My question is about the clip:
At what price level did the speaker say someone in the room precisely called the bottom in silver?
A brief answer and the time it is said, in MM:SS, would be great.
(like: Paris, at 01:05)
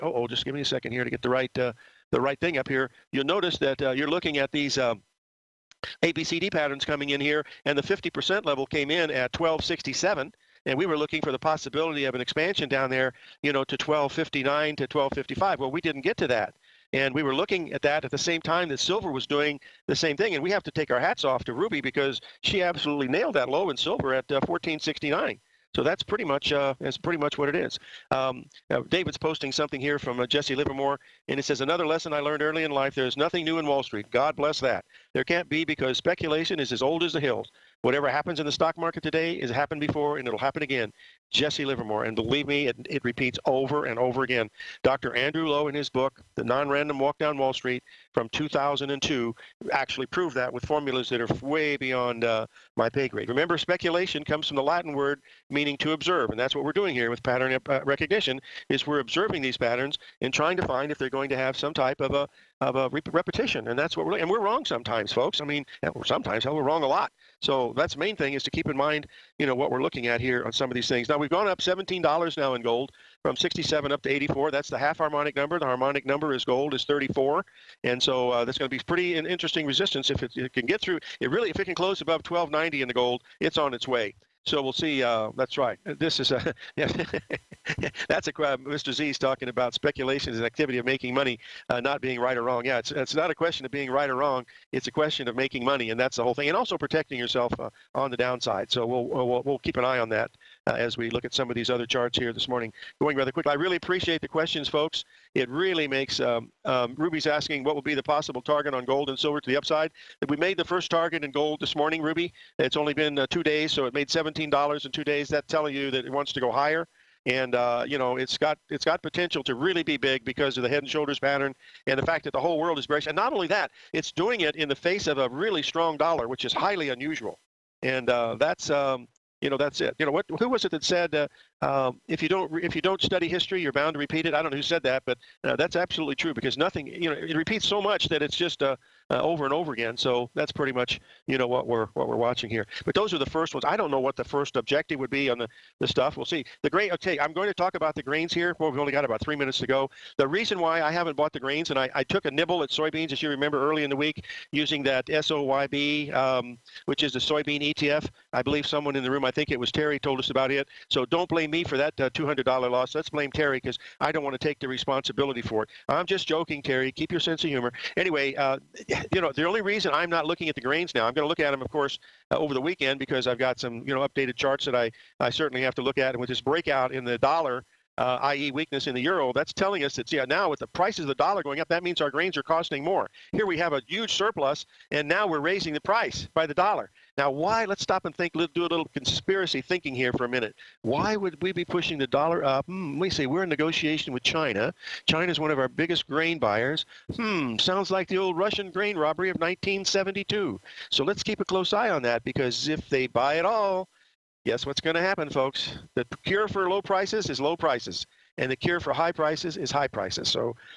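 1469, at 00:24.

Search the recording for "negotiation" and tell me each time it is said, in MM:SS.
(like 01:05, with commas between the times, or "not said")
03:13.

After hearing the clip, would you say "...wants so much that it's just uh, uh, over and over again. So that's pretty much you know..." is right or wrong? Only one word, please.
wrong.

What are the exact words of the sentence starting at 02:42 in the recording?
Let's blame Terry because I don't want to take the responsibility for it.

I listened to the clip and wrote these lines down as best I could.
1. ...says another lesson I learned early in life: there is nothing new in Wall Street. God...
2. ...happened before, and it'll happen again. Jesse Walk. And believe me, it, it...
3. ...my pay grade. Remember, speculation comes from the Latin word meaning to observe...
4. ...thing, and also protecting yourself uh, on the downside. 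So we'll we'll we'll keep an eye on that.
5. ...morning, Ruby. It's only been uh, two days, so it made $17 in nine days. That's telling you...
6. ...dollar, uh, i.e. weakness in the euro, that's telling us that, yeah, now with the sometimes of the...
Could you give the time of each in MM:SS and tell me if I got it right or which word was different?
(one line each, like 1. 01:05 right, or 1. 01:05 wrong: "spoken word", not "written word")
1. 00:31 right
2. 00:39 wrong: "Livermore", not "Walk"
3. 00:52 right
4. 01:36 right
5. 01:51 wrong: "two", not "nine"
6. 02:57 wrong: "prices", not "sometimes".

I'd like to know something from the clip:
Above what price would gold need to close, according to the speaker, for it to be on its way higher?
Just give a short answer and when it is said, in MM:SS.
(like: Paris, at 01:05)
1290, at 01:22.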